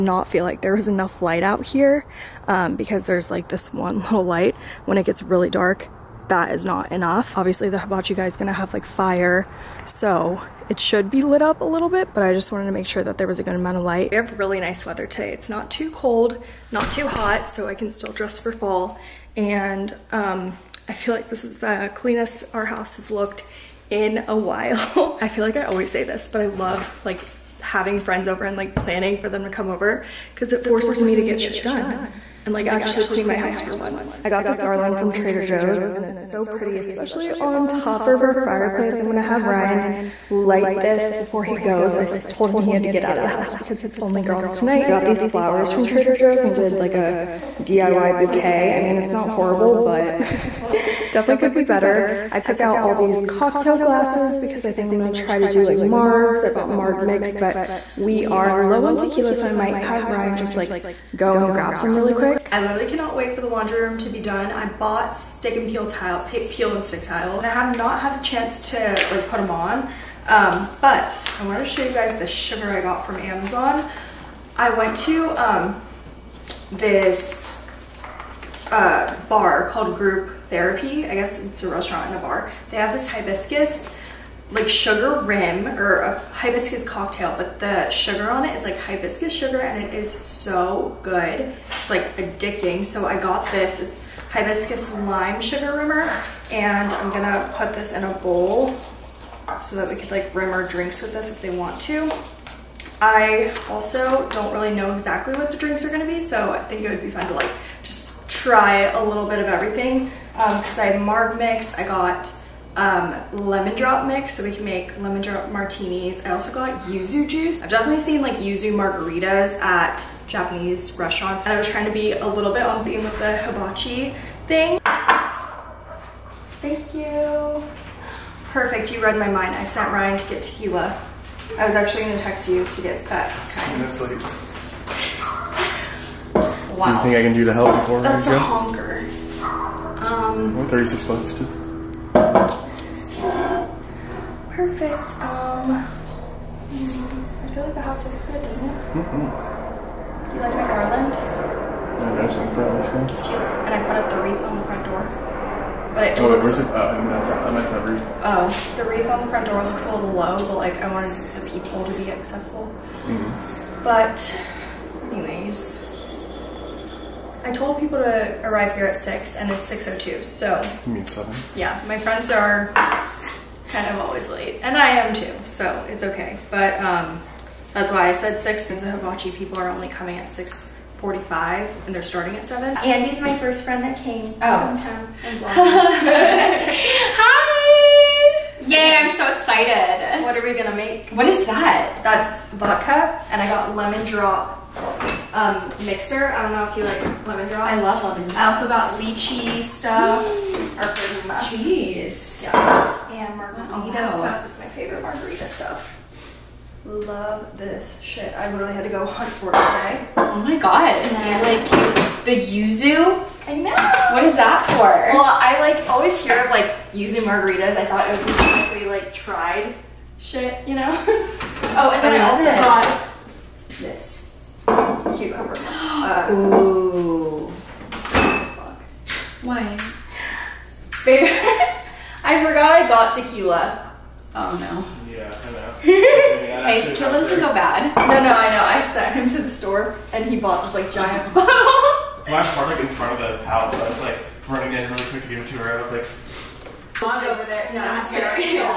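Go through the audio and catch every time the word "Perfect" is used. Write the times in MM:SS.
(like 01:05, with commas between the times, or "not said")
02:08, 02:22.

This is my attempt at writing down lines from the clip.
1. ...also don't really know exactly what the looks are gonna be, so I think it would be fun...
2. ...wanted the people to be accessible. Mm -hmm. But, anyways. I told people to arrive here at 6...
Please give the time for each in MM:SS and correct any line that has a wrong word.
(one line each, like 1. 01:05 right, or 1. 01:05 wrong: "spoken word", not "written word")
1. 01:43 wrong: "drinks", not "looks"
2. 02:40 right.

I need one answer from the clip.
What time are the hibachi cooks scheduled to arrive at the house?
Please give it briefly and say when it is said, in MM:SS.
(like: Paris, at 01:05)
6:45, at 03:00.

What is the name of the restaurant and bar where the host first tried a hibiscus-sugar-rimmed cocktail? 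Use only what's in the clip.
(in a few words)
Group Therapy.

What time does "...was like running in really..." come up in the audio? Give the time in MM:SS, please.
04:03.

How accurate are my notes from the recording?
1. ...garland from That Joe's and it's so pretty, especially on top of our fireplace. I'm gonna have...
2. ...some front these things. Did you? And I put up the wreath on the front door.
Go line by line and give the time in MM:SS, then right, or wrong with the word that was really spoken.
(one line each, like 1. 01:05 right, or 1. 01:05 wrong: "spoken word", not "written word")
1. 00:34 wrong: "Trader", not "That"
2. 02:32 right.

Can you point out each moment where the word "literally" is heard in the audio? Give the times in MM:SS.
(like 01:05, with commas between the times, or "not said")
01:02, 03:28.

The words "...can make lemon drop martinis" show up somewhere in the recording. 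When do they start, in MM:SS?
01:54.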